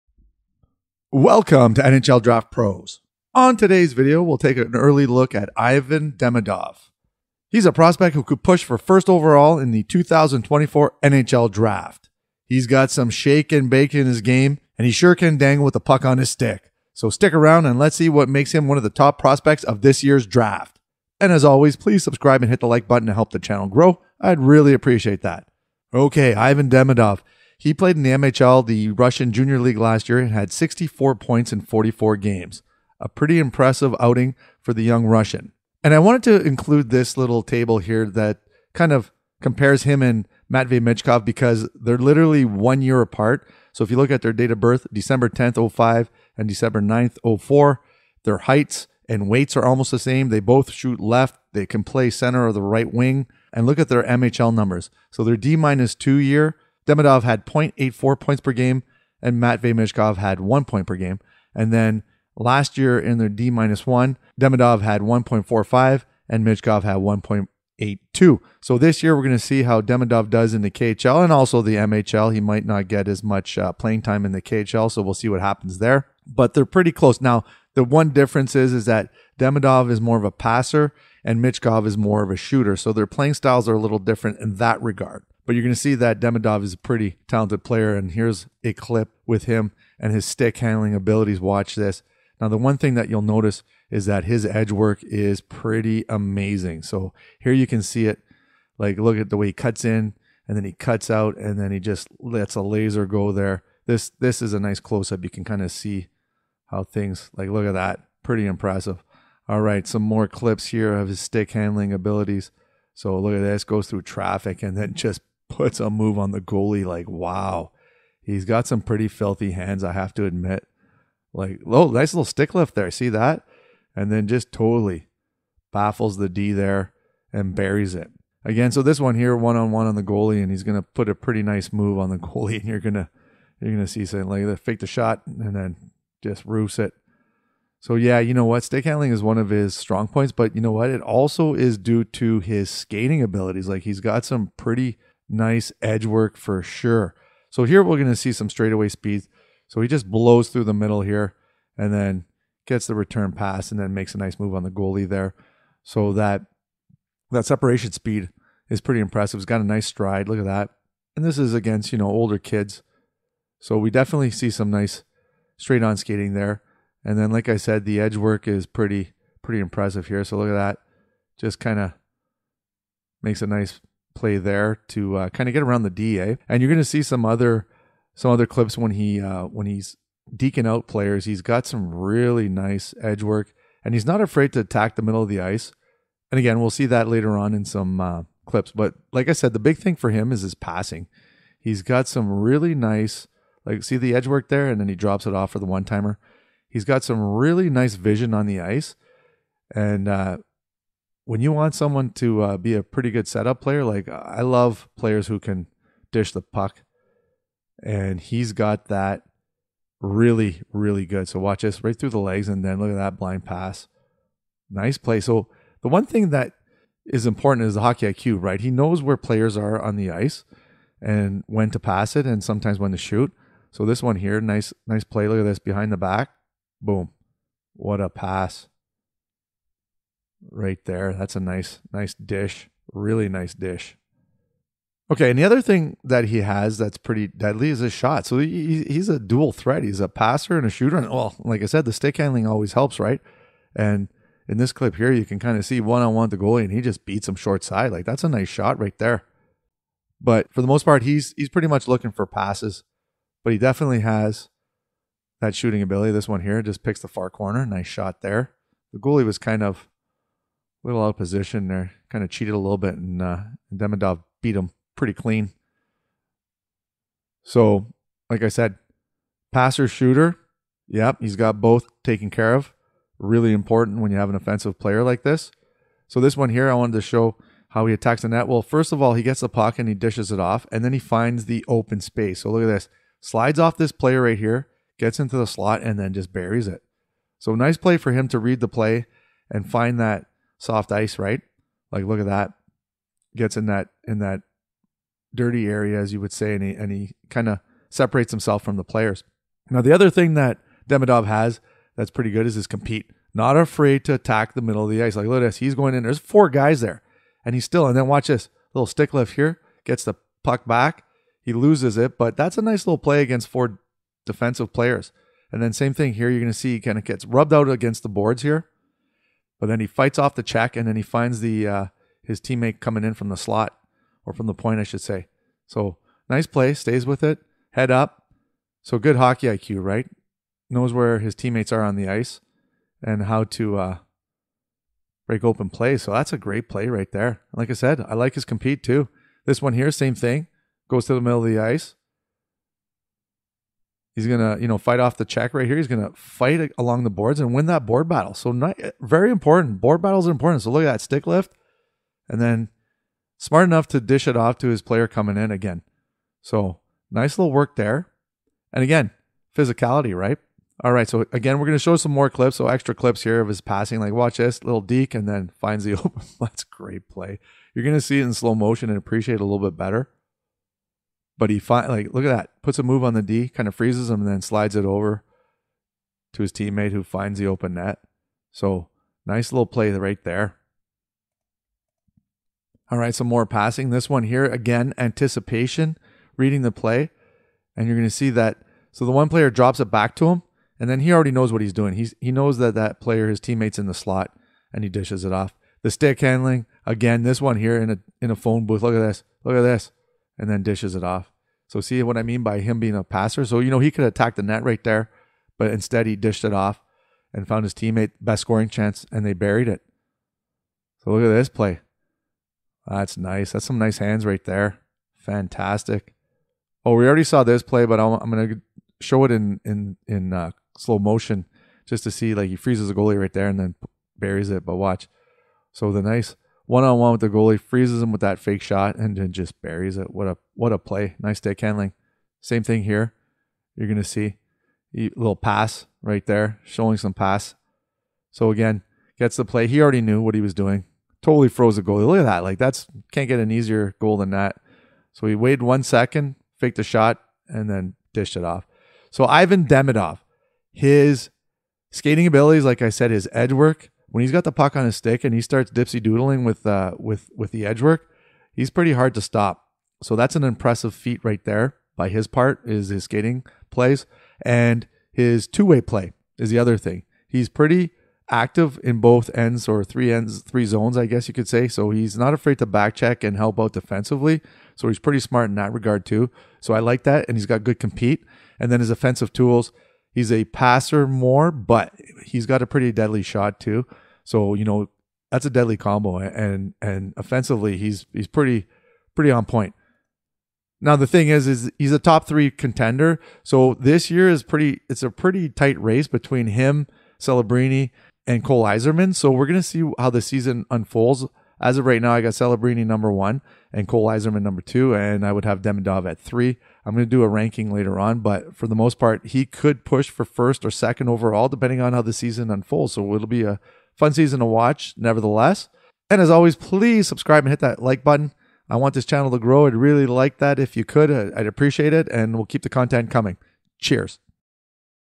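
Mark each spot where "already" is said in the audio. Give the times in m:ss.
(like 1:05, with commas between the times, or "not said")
6:31, 6:57, 7:19.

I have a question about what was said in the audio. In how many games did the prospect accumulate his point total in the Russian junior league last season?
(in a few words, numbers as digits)
44.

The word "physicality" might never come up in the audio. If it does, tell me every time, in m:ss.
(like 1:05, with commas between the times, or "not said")
5:59.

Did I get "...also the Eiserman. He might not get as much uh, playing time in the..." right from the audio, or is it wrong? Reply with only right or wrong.
wrong.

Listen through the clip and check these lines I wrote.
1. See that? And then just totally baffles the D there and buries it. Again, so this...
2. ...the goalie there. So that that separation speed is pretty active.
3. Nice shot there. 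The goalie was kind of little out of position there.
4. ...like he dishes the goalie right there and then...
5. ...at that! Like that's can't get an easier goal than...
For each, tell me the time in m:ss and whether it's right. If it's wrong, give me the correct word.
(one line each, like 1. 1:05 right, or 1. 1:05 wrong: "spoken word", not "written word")
1. 2:02 right
2. 2:34 wrong: "impressive", not "active"
3. 4:17 right
4. 7:02 wrong: "freezes", not "dishes"
5. 7:22 right.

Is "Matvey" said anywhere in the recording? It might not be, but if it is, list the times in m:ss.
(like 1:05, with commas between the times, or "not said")
0:40, 0:59.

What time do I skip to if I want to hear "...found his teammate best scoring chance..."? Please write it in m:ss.
6:47.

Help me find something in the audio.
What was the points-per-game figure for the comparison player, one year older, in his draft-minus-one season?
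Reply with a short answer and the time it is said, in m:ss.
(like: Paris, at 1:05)
1.82, at 1:06.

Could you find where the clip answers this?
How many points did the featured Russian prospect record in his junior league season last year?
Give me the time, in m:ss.
0:30.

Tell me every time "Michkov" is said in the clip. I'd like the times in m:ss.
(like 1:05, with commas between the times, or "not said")
0:40, 0:59, 1:06, 1:21.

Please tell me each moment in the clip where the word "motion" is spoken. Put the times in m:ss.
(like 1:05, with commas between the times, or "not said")
6:08, 7:00.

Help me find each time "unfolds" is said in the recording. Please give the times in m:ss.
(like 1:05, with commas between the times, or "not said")
8:20, 8:32.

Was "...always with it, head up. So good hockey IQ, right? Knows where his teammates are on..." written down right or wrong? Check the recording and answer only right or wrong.
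wrong.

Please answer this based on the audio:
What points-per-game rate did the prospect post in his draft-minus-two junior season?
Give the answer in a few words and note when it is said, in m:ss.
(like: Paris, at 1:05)
0.84, at 0:57.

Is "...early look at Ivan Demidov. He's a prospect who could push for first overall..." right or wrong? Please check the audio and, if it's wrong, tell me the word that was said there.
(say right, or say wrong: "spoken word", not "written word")
right.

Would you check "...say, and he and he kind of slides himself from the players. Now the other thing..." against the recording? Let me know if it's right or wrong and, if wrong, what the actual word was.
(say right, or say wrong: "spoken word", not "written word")
wrong: "separates", not "slides".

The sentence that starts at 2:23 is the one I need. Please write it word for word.
Like he's got some pretty Nice edge work for sure.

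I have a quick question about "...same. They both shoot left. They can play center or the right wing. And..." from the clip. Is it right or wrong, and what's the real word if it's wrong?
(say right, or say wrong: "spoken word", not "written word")
right.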